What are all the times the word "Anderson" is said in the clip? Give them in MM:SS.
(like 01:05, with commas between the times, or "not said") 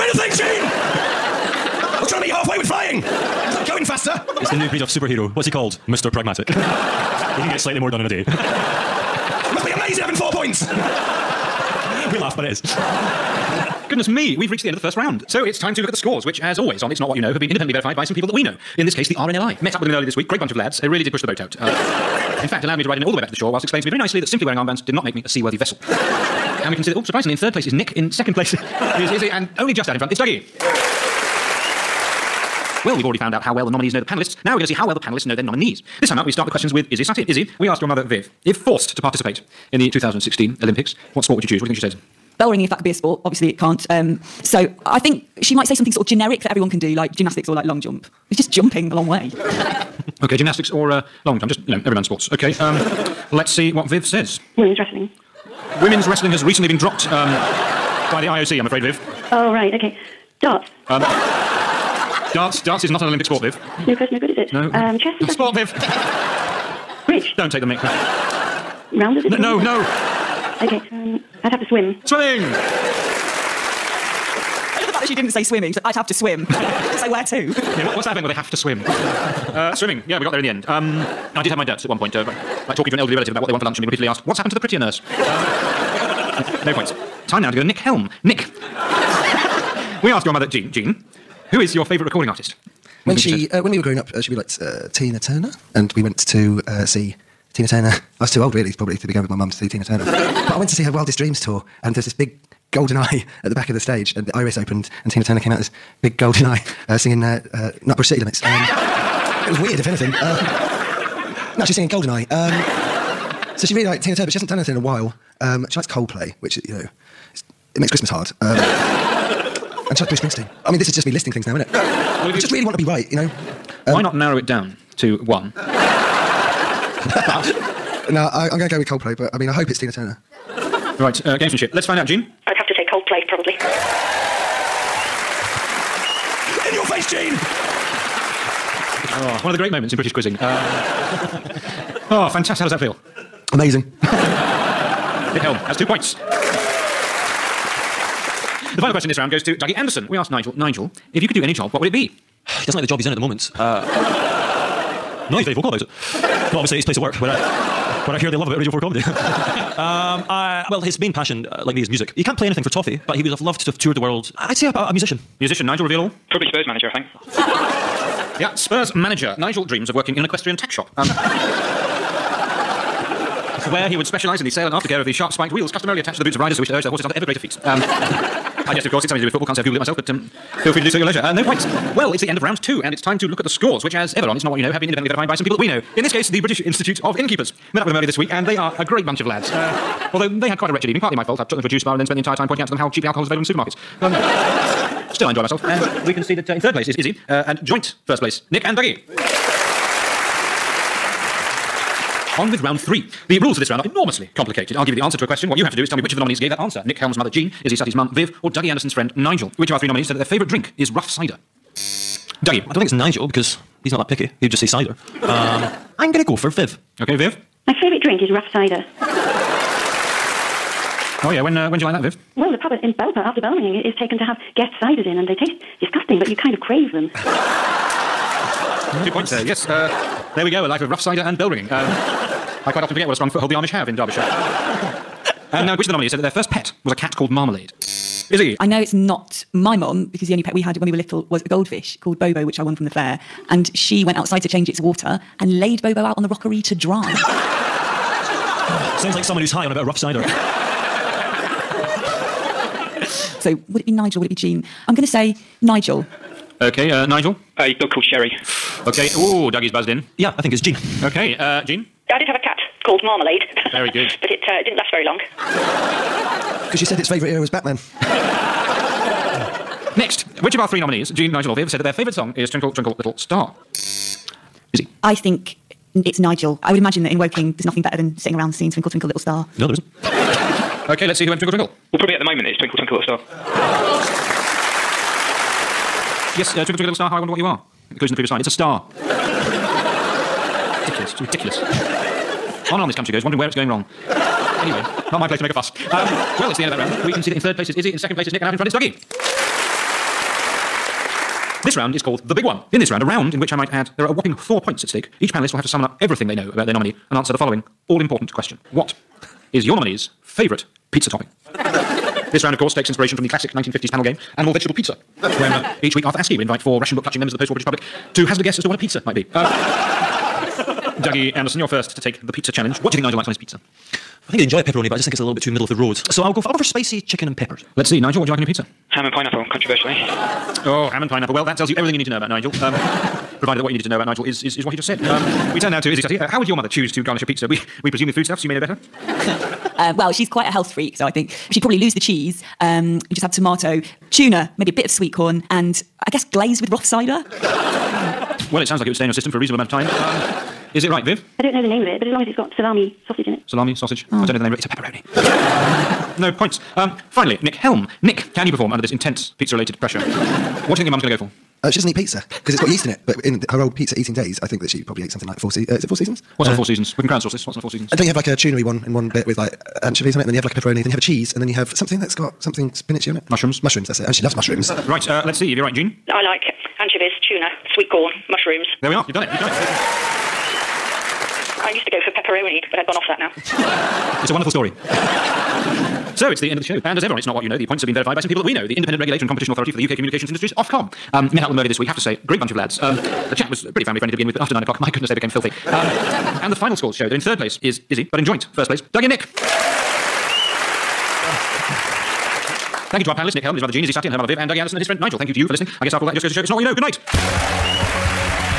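02:29, 03:28, 05:21, 06:44.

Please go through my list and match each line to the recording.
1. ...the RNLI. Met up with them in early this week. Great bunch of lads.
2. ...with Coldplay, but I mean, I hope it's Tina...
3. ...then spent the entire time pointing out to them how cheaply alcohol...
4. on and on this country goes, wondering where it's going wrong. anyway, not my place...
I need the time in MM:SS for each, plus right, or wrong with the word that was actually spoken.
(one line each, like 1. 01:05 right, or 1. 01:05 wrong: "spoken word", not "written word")
1. 00:19 right
2. 02:08 right
3. 03:11 right
4. 04:52 right.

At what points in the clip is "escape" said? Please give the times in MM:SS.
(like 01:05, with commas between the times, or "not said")
not said.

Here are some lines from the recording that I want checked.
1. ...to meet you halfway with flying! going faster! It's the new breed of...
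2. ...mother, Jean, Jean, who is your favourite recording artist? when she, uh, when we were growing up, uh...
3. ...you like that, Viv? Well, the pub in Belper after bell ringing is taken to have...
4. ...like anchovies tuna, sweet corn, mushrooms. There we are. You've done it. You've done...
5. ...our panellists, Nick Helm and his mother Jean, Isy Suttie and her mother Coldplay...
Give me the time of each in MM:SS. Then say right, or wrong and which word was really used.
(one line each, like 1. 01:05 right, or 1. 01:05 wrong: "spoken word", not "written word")
1. 00:02 right
2. 01:30 right
3. 03:41 right
4. 06:16 right
5. 06:43 wrong: "Viv", not "Coldplay".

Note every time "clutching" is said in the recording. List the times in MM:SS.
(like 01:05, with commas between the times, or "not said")
05:17.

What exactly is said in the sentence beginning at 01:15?
She said, I'd have to swim.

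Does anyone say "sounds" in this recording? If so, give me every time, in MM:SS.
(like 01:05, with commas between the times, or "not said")
04:08, 05:48.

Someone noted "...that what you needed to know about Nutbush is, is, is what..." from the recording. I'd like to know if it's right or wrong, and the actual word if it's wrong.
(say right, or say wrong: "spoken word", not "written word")
wrong: "Nigel", not "Nutbush".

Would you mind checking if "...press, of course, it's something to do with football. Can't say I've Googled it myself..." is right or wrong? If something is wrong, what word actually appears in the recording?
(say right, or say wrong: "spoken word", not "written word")
wrong: "guess", not "press".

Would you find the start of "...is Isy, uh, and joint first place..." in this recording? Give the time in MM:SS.
03:16.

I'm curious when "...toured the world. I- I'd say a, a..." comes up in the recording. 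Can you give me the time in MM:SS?
02:43.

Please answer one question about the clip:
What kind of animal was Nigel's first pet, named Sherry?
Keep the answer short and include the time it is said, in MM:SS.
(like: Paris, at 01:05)
A dog, at 04:17.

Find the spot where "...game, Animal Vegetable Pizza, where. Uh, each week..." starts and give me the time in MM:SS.
05:14.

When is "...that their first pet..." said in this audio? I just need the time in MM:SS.
03:56.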